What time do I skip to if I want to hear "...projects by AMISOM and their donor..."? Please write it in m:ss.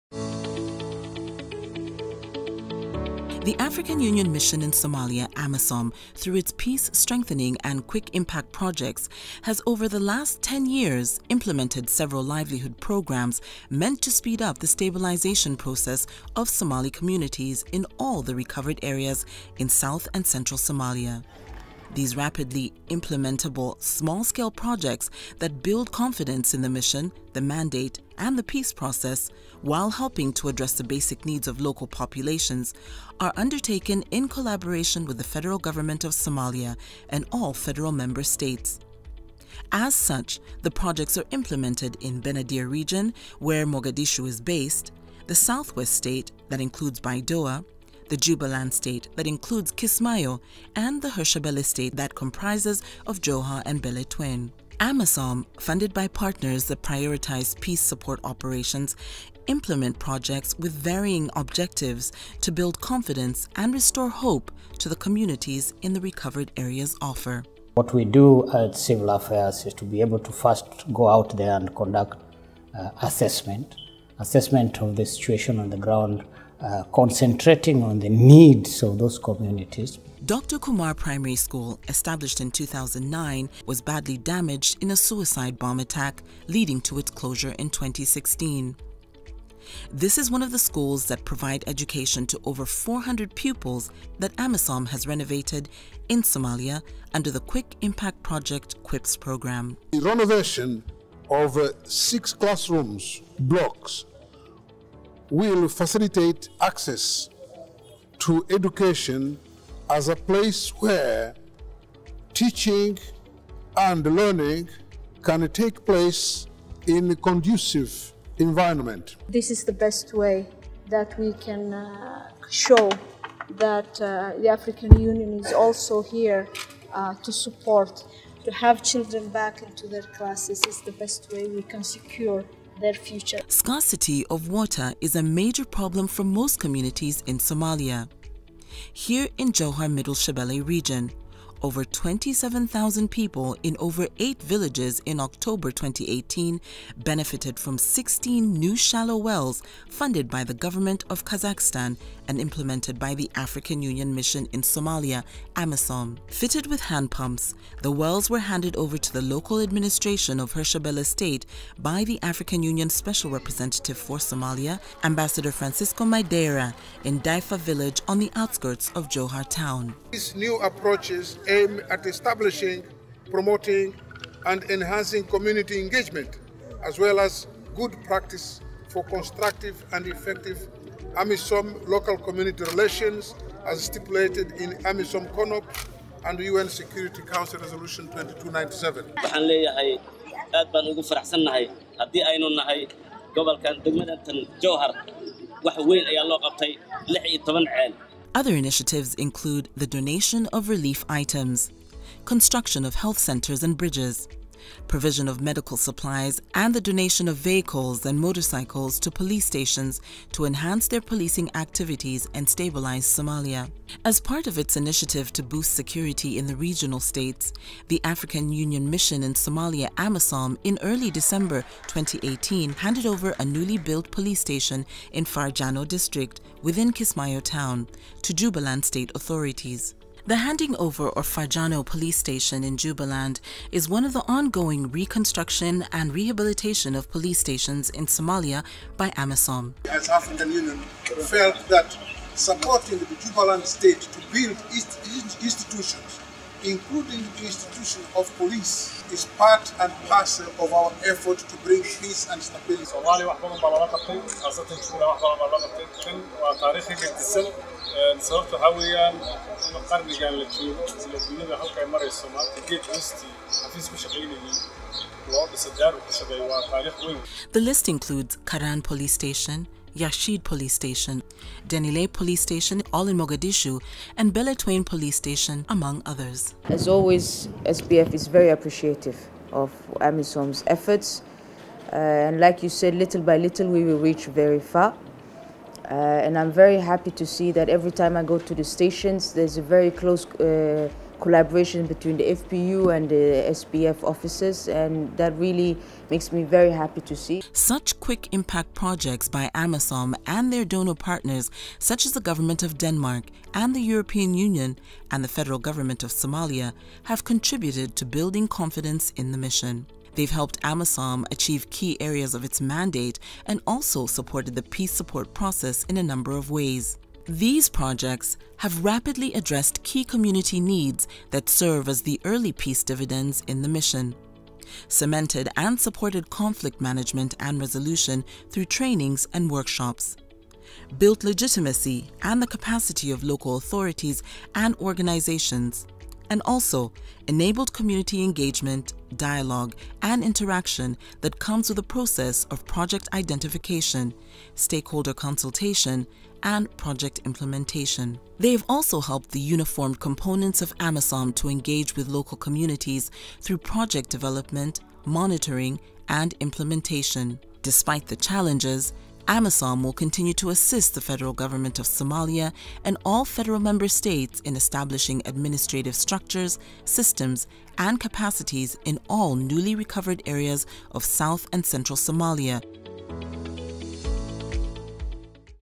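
4:58.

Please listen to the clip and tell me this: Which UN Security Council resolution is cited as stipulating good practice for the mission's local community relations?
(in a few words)
Resolution 2297.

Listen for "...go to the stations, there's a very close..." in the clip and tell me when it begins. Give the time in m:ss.
4:48.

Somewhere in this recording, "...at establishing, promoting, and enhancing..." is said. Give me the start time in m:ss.
2:51.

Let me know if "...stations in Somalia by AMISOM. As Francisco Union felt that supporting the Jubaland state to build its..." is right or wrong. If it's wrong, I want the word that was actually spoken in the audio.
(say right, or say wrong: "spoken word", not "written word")
wrong: "African", not "Francisco".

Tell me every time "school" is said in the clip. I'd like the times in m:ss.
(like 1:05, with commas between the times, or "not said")
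1:21, 1:30.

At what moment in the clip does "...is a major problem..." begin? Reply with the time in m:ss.
2:15.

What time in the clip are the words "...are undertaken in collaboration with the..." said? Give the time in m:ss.
0:33.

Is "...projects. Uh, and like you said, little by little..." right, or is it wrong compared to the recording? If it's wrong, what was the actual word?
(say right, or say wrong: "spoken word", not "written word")
wrong: "efforts", not "projects".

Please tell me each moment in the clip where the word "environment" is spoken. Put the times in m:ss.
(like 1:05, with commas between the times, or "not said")
1:58.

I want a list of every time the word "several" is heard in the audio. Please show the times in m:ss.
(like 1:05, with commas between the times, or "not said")
0:11.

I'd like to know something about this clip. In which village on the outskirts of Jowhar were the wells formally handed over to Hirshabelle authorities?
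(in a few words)
Daifa.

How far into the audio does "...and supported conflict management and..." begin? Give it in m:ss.
5:25.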